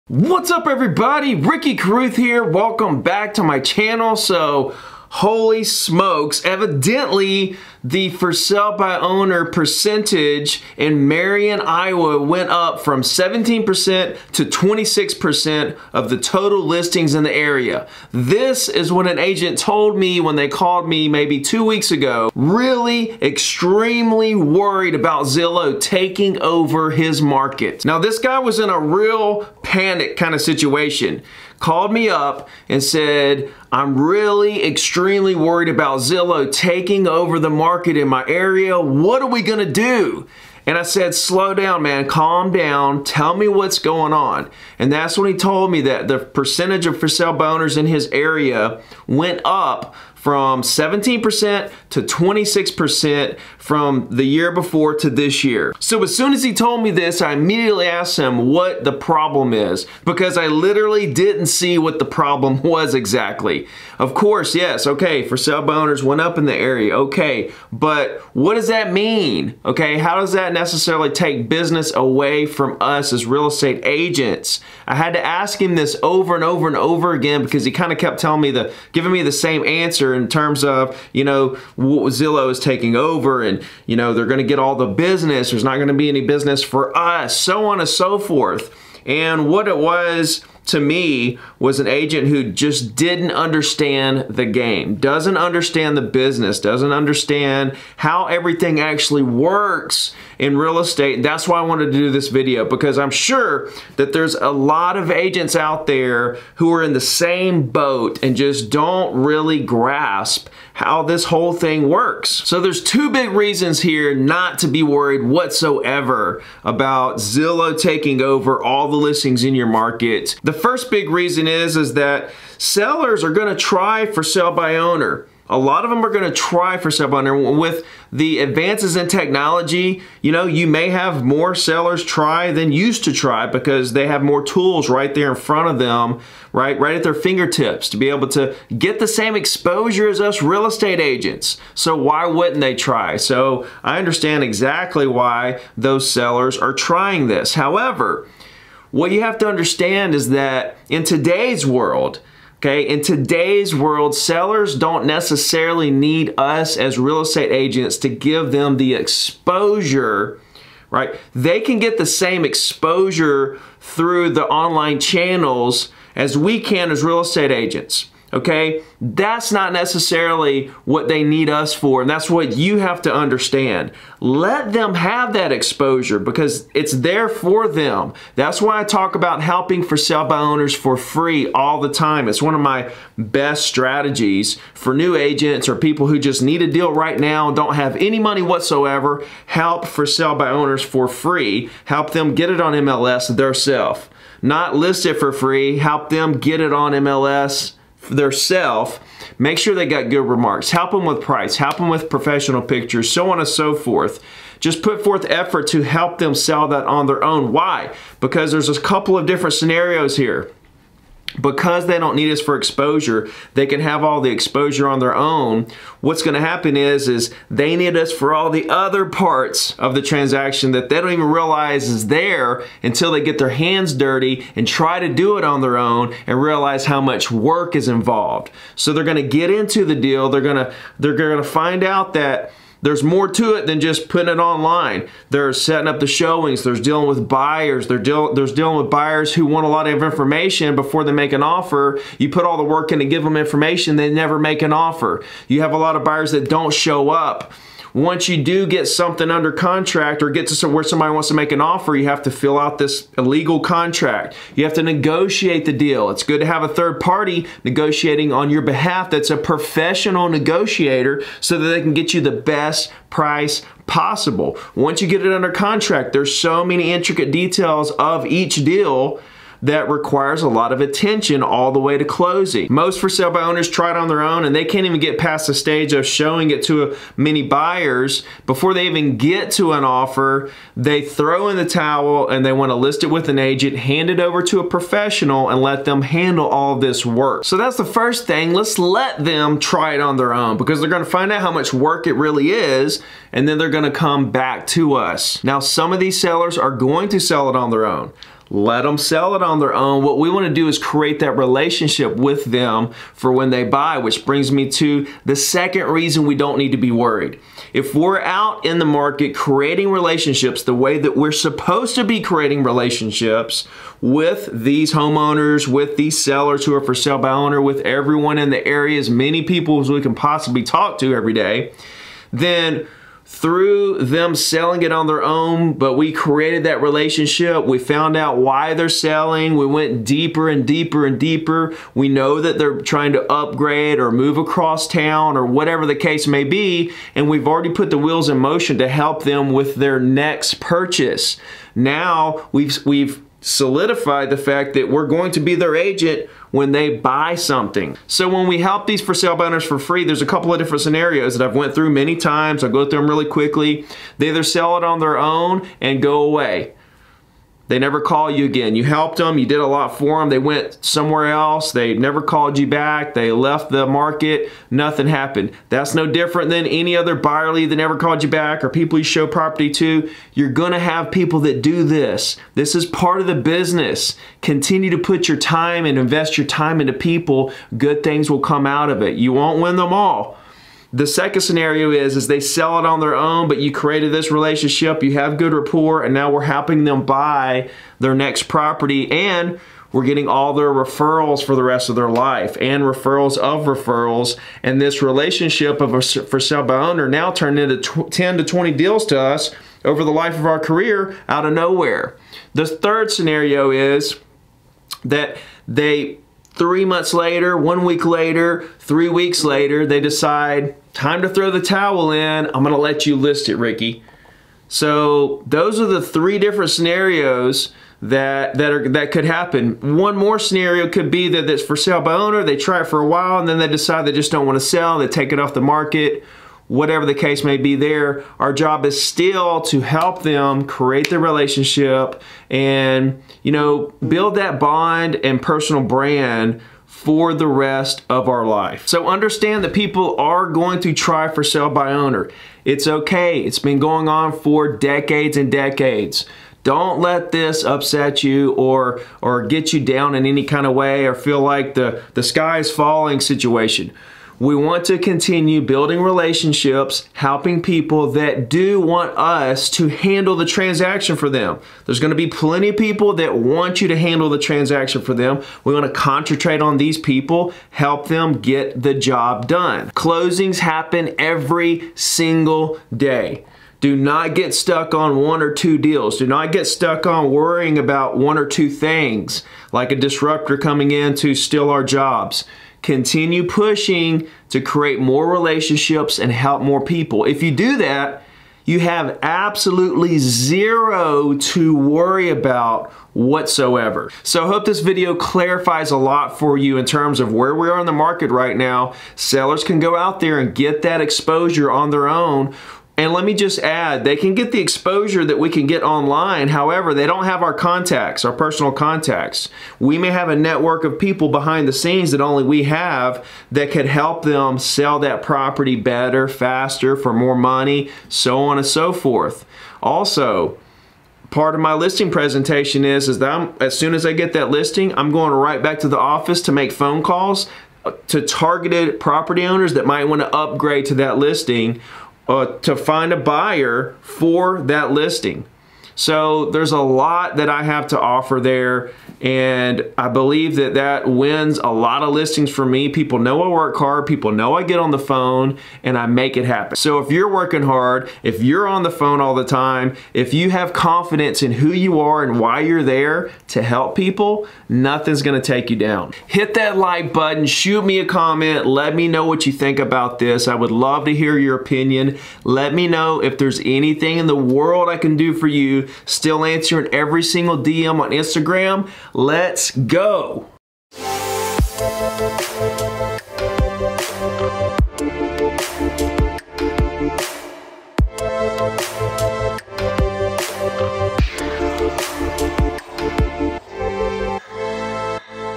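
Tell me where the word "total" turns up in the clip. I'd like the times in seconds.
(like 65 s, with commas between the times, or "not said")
16 s.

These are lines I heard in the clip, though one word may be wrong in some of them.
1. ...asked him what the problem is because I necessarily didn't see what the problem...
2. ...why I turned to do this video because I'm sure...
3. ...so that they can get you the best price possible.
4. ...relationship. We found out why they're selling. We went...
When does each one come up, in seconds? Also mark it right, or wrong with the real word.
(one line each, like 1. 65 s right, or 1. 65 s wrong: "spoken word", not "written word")
1. 57 s wrong: "literally", not "necessarily"
2. 101 s wrong: "wanted", not "turned"
3. 261 s right
4. 326 s right.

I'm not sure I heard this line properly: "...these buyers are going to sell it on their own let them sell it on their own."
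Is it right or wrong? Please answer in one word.
wrong.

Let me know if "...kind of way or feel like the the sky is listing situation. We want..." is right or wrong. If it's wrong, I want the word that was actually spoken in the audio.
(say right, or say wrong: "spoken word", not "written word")
wrong: "falling", not "listing".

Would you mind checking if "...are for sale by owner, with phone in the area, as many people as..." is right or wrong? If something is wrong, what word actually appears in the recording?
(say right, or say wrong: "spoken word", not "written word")
wrong: "everyone", not "phone".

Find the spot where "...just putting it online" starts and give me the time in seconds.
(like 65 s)
233 s.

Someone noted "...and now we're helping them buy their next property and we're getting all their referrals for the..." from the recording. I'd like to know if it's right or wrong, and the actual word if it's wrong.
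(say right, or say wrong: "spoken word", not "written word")
right.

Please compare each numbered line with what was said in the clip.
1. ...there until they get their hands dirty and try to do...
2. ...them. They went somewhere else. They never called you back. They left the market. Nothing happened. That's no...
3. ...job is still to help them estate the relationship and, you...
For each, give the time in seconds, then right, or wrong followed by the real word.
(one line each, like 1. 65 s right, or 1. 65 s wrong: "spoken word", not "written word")
1. 222 s right
2. 360 s right
3. 428 s wrong: "create", not "estate".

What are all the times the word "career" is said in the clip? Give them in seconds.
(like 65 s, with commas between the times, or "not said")
400 s.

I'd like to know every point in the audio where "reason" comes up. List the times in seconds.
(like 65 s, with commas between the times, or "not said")
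113 s, 121 s, 305 s.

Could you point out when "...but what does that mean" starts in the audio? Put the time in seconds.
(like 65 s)
67 s.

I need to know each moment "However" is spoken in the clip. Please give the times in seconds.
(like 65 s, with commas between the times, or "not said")
147 s, 506 s.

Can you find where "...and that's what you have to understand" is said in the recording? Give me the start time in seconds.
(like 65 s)
172 s.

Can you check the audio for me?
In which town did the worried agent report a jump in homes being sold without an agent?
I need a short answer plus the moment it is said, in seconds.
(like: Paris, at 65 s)
Marion, Iowa, at 11 s.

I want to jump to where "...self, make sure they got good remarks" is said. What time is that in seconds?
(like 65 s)
198 s.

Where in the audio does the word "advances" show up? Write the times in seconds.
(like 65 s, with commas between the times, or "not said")
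128 s.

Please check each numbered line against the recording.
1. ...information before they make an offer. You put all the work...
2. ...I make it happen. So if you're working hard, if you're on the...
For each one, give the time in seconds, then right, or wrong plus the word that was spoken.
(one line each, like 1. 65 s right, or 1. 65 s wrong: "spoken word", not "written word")
1. 240 s right
2. 545 s right.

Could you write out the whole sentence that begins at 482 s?
Continue pushing to create more relationships and help more people.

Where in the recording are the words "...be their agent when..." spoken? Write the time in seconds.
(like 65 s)
345 s.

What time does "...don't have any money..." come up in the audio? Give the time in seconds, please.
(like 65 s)
187 s.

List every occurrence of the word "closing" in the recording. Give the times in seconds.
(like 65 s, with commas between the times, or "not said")
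272 s, 469 s.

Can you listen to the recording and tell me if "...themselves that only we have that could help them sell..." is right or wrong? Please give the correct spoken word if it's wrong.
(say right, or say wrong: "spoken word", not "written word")
wrong: "scenes", not "themselves".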